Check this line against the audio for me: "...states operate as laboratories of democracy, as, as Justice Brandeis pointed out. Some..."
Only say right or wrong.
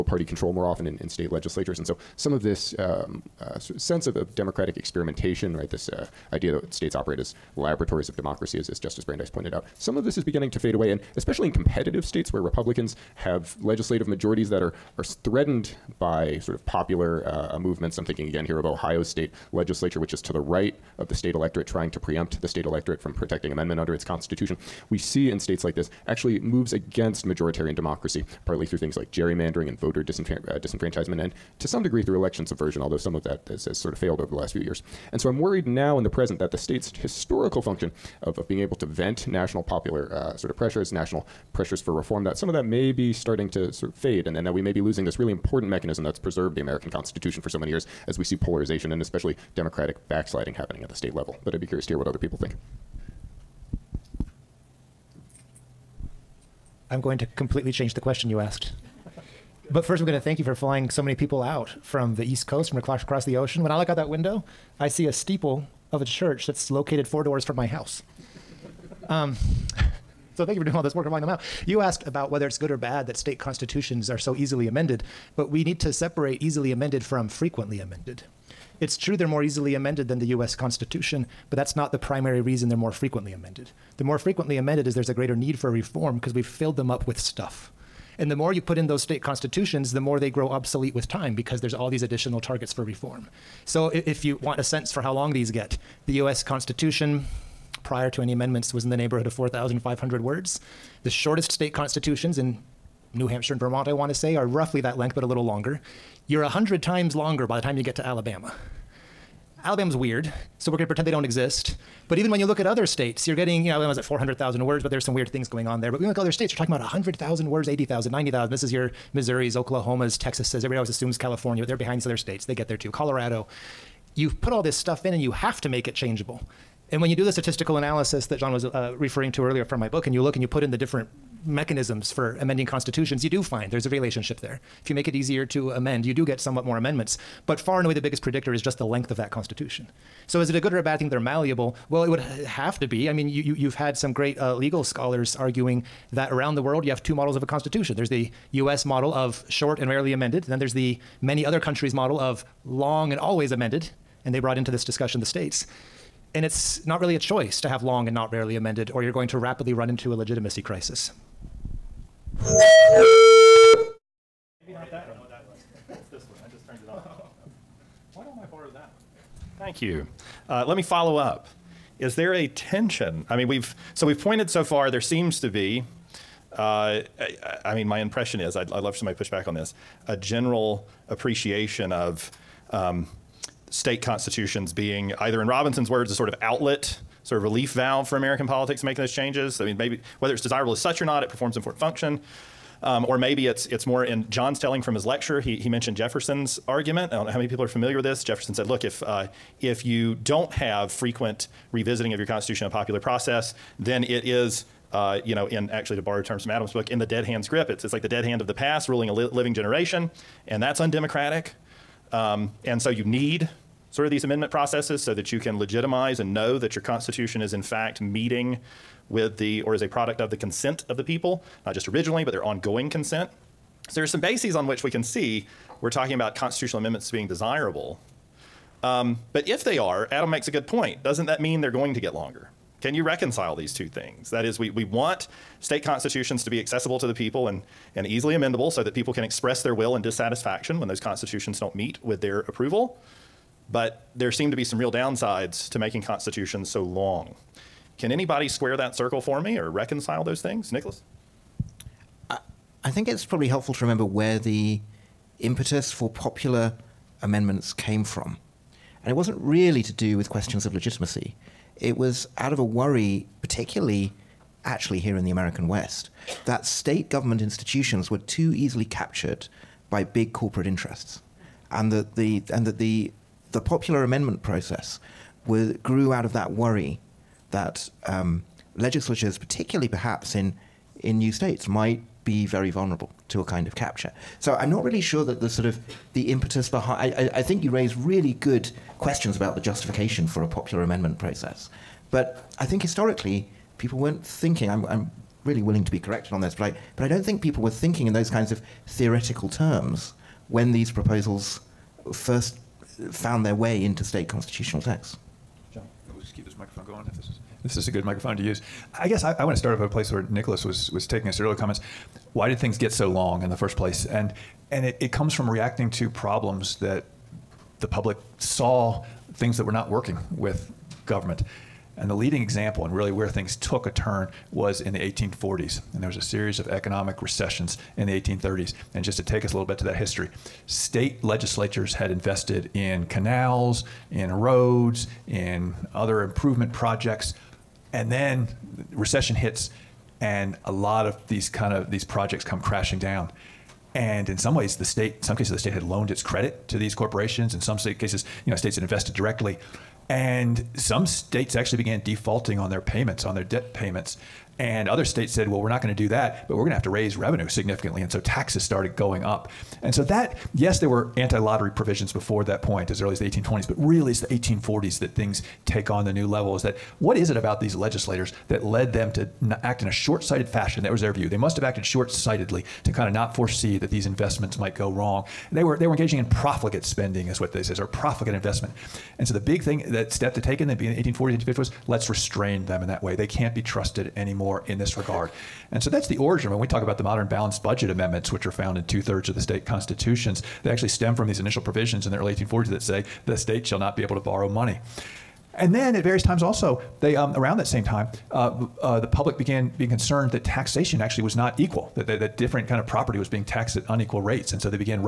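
right.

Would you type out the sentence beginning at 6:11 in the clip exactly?
They must have acted short sightedly to kind of not foresee that these investments might go wrong.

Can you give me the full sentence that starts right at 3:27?
It's it's like the dead hand of the past ruling a li- living generation, and that's undemocratic.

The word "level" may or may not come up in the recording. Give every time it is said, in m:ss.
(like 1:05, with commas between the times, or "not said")
0:51, 6:06.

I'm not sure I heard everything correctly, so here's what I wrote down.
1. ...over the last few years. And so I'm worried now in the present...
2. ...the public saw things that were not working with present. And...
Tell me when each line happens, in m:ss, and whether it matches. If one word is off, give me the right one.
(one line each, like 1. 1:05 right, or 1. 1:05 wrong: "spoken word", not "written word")
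1. 0:34 right
2. 5:17 wrong: "government", not "present".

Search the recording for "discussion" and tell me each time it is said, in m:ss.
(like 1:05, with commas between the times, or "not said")
2:34.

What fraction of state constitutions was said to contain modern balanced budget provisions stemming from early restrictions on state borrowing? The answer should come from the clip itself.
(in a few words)
Two thirds.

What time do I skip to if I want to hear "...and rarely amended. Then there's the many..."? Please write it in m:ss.
2:29.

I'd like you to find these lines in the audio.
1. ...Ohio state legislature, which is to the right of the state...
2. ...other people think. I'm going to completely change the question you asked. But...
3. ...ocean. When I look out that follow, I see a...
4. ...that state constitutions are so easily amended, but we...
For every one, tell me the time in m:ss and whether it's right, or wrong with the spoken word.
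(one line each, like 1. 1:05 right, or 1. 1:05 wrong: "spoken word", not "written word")
1. 0:18 right
2. 0:52 right
3. 1:03 wrong: "window", not "follow"
4. 1:13 right.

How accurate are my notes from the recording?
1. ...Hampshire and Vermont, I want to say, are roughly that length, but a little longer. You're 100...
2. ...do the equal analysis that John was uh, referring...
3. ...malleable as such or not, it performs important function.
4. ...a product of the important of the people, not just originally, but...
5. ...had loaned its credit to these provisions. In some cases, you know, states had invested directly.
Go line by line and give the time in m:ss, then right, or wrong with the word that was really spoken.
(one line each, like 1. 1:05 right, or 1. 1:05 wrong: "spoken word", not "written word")
1. 1:43 right
2. 2:07 wrong: "statistical", not "equal"
3. 3:10 wrong: "desirable", not "malleable"
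4. 3:39 wrong: "consent", not "important"
5. 5:45 wrong: "corporations", not "provisions".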